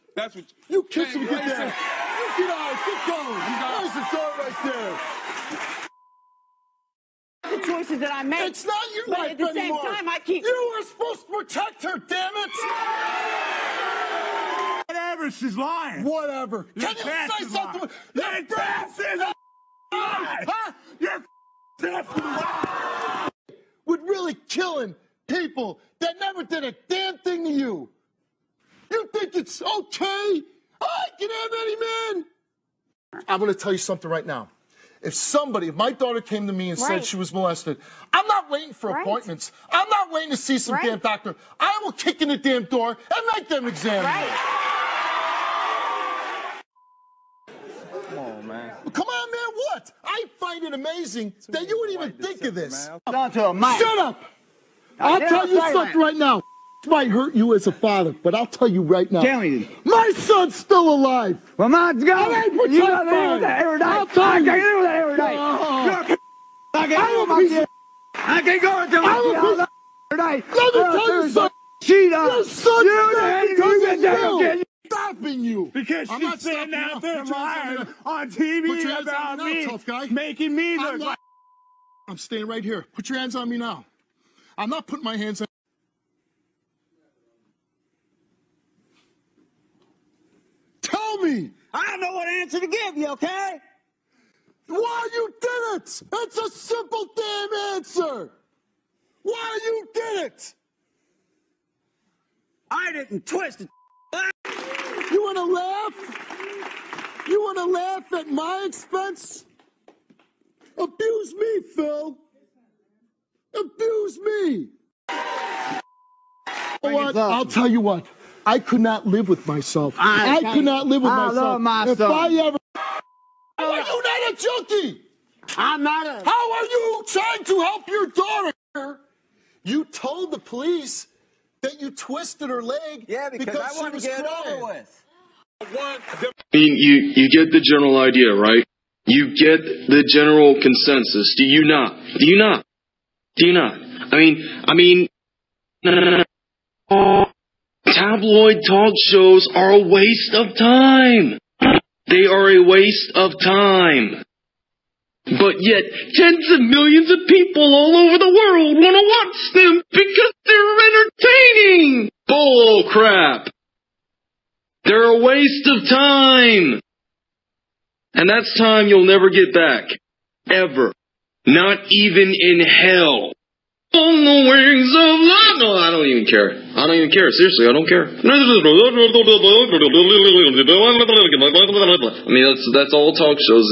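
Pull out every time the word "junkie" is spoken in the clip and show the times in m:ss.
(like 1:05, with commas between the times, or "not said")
2:04.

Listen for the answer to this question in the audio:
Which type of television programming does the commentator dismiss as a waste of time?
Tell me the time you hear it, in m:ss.
2:27.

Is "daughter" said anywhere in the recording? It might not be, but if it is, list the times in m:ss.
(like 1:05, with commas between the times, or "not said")
0:35, 2:08.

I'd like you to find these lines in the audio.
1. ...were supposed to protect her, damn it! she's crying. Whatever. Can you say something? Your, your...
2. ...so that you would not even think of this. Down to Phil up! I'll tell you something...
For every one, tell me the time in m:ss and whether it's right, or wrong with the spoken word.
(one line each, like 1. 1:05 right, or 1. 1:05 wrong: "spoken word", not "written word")
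1. 0:10 wrong: "lying", not "crying"
2. 0:51 wrong: "Shut", not "Phil".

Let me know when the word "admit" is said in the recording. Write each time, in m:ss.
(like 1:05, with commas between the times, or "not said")
not said.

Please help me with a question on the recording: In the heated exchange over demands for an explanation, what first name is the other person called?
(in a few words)
Phil.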